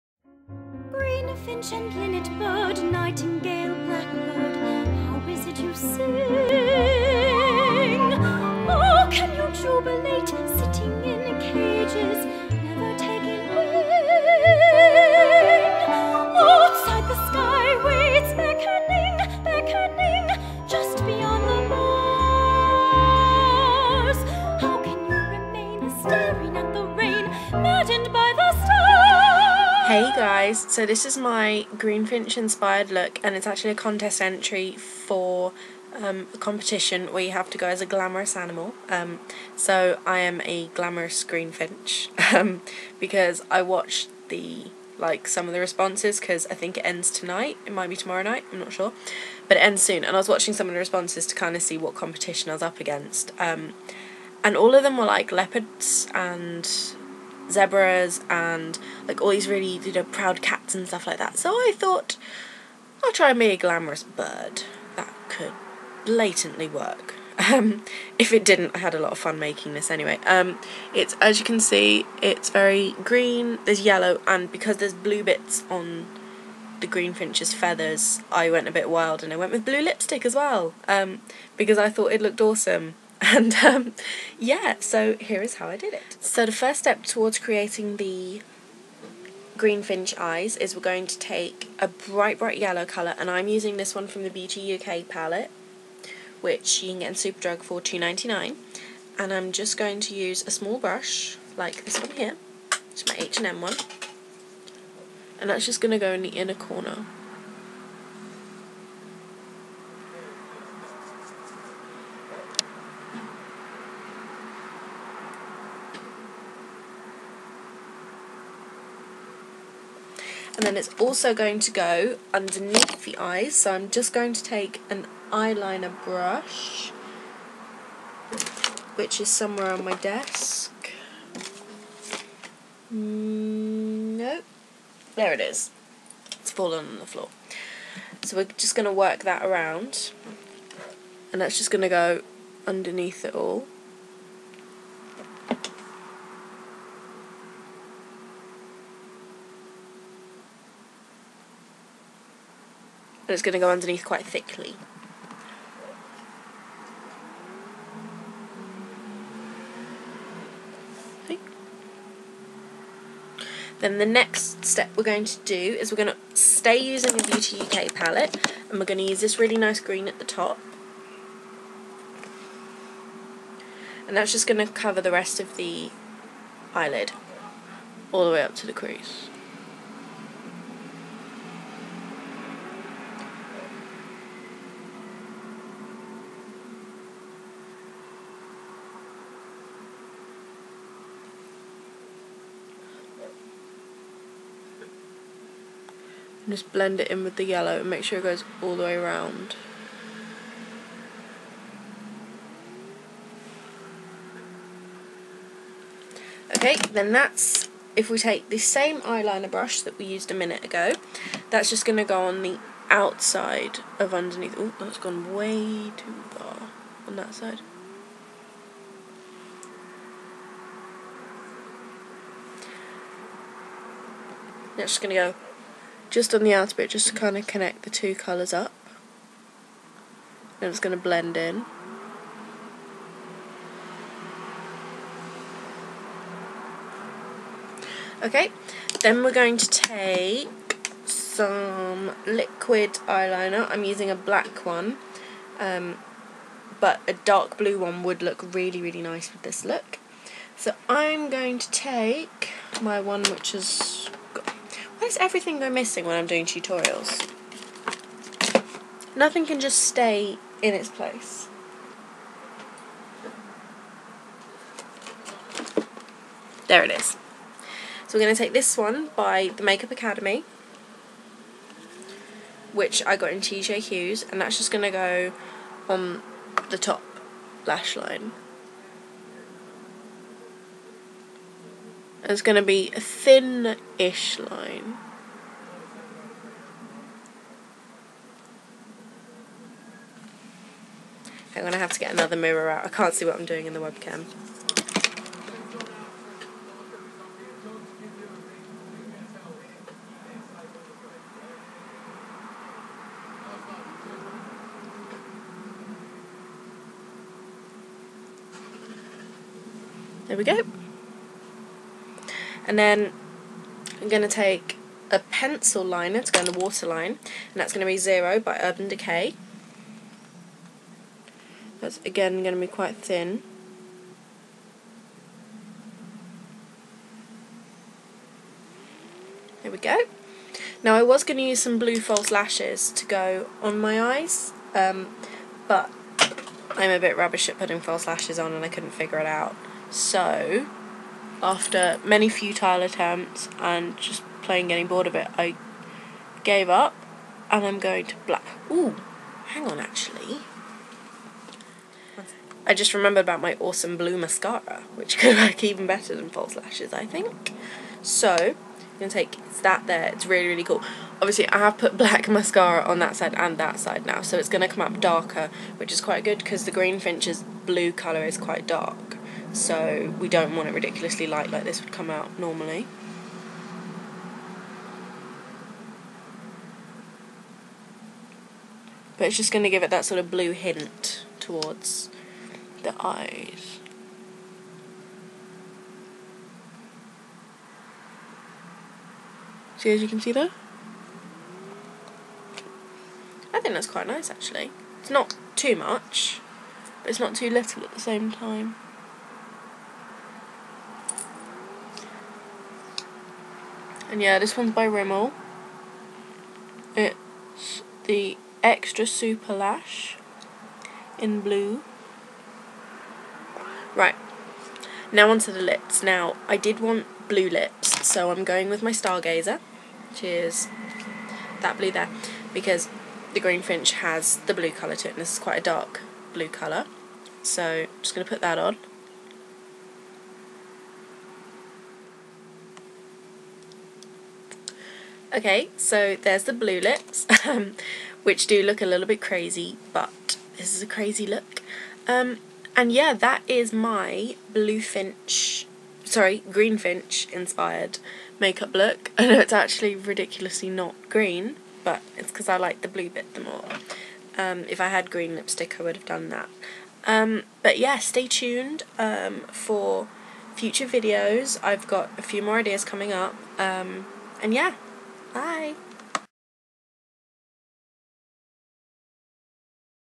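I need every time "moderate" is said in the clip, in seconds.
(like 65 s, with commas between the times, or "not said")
not said.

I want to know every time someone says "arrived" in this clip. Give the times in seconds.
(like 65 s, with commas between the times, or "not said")
not said.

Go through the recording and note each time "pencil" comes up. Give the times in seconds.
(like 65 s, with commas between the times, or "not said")
315 s.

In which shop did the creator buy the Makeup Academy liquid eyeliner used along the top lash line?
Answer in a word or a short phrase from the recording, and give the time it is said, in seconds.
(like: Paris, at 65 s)
TJ Hughes, at 273 s.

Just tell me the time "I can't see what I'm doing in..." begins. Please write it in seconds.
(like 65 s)
292 s.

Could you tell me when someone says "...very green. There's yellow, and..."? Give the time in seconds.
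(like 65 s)
72 s.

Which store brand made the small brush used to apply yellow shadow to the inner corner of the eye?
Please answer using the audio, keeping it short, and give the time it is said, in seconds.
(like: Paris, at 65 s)
H&M, at 103 s.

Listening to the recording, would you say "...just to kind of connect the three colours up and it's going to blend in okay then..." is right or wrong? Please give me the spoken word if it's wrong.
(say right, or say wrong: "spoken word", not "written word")
wrong: "two", not "three".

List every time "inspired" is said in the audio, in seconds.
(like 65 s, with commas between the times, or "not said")
32 s, 447 s.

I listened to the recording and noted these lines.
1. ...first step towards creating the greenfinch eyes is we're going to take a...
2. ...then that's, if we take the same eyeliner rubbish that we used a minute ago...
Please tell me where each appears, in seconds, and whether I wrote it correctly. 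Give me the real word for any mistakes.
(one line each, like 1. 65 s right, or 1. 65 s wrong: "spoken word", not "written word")
1. 86 s right
2. 206 s wrong: "brush", not "rubbish".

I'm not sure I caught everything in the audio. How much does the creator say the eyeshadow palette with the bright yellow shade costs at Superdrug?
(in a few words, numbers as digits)
£2.99.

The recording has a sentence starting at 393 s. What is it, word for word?
I think that's quite nice actually.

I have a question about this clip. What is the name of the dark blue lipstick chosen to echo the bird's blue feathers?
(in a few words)
Stargazer.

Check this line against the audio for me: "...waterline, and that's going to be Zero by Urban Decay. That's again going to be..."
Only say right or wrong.
right.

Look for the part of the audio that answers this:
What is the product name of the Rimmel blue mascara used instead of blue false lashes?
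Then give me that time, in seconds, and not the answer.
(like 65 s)
408 s.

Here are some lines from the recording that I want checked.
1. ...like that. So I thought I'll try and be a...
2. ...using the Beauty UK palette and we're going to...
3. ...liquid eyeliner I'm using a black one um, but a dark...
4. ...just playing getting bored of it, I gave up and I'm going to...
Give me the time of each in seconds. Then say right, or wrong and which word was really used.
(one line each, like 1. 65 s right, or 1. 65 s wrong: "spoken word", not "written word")
1. 61 s right
2. 166 s right
3. 242 s right
4. 343 s right.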